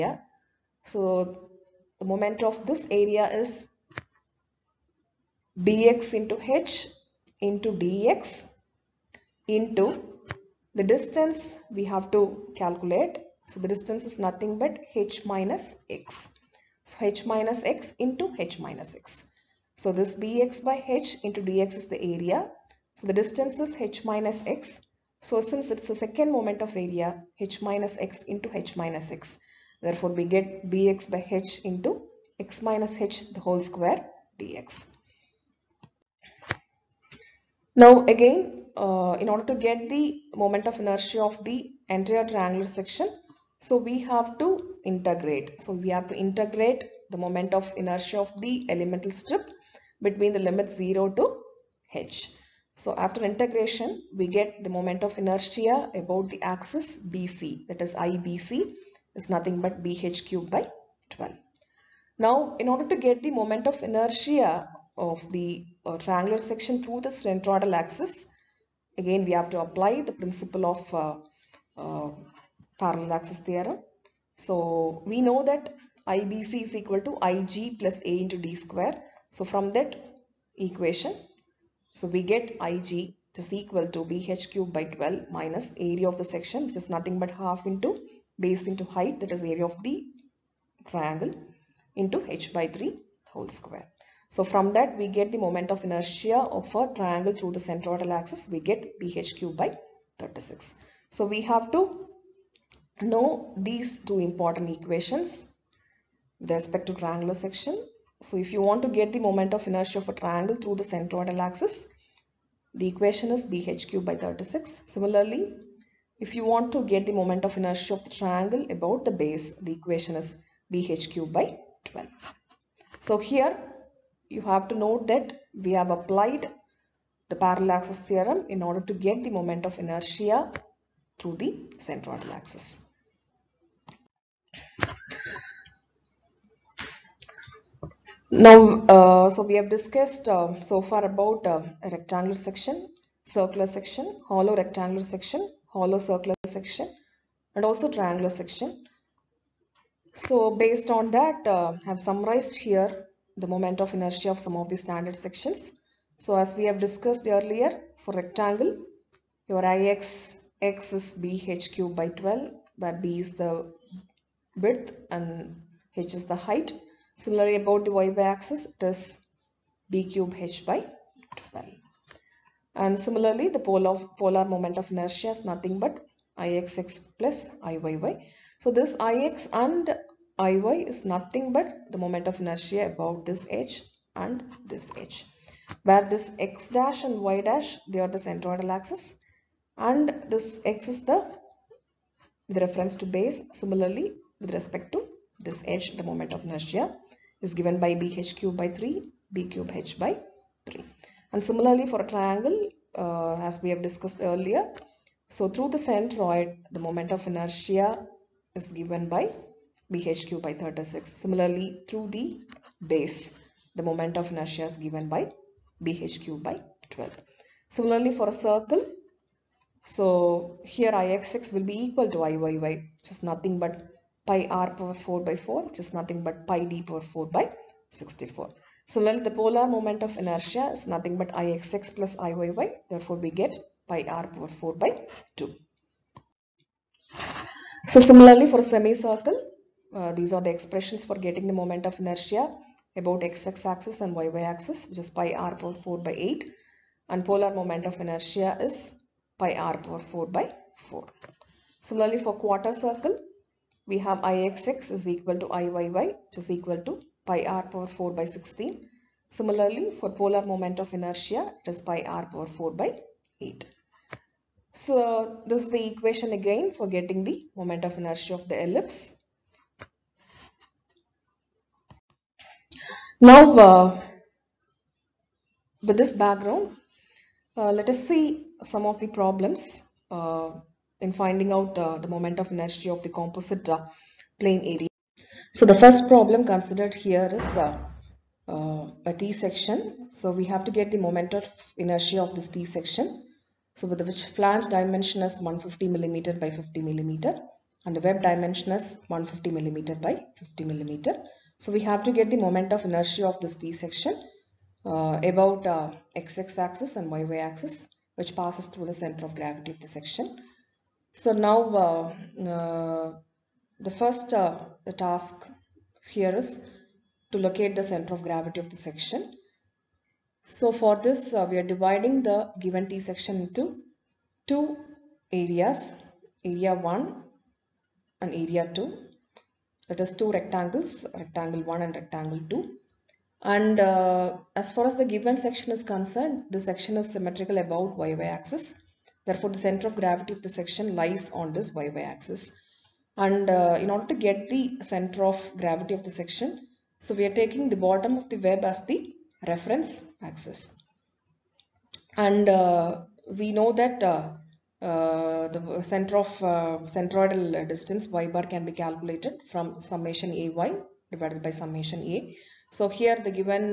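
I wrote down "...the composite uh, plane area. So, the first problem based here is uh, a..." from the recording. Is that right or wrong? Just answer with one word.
wrong.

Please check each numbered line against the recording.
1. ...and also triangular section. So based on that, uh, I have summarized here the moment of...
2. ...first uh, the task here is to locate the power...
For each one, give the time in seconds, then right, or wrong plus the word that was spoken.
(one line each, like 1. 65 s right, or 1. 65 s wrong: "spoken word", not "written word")
1. 147 s right
2. 313 s wrong: "center", not "power".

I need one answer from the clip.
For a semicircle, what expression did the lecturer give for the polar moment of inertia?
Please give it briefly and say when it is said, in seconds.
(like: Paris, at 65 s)
pi r^4 / 4, at 247 s.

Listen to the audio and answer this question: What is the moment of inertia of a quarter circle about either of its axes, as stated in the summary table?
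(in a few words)
pi r^4 / 16.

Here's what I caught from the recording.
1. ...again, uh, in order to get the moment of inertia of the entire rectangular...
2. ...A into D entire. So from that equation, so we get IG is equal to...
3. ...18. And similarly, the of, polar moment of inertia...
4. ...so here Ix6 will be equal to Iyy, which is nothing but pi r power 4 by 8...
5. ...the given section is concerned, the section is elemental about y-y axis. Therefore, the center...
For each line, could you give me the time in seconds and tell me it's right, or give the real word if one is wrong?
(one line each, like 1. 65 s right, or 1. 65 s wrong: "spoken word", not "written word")
1. 38 s wrong: "triangular", not "rectangular"
2. 78 s wrong: "square", not "entire"
3. 171 s wrong: "12", not "18"
4. 219 s wrong: "4", not "8"
5. 334 s wrong: "symmetrical", not "elemental".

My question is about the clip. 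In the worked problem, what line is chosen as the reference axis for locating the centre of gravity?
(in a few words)
bottom of the web.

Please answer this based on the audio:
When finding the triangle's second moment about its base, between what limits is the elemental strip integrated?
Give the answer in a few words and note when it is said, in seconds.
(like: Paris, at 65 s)
0 to h, at 50 s.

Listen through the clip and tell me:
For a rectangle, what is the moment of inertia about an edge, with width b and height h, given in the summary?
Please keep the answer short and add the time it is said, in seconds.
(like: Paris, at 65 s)
bh^3 / 3, at 198 s.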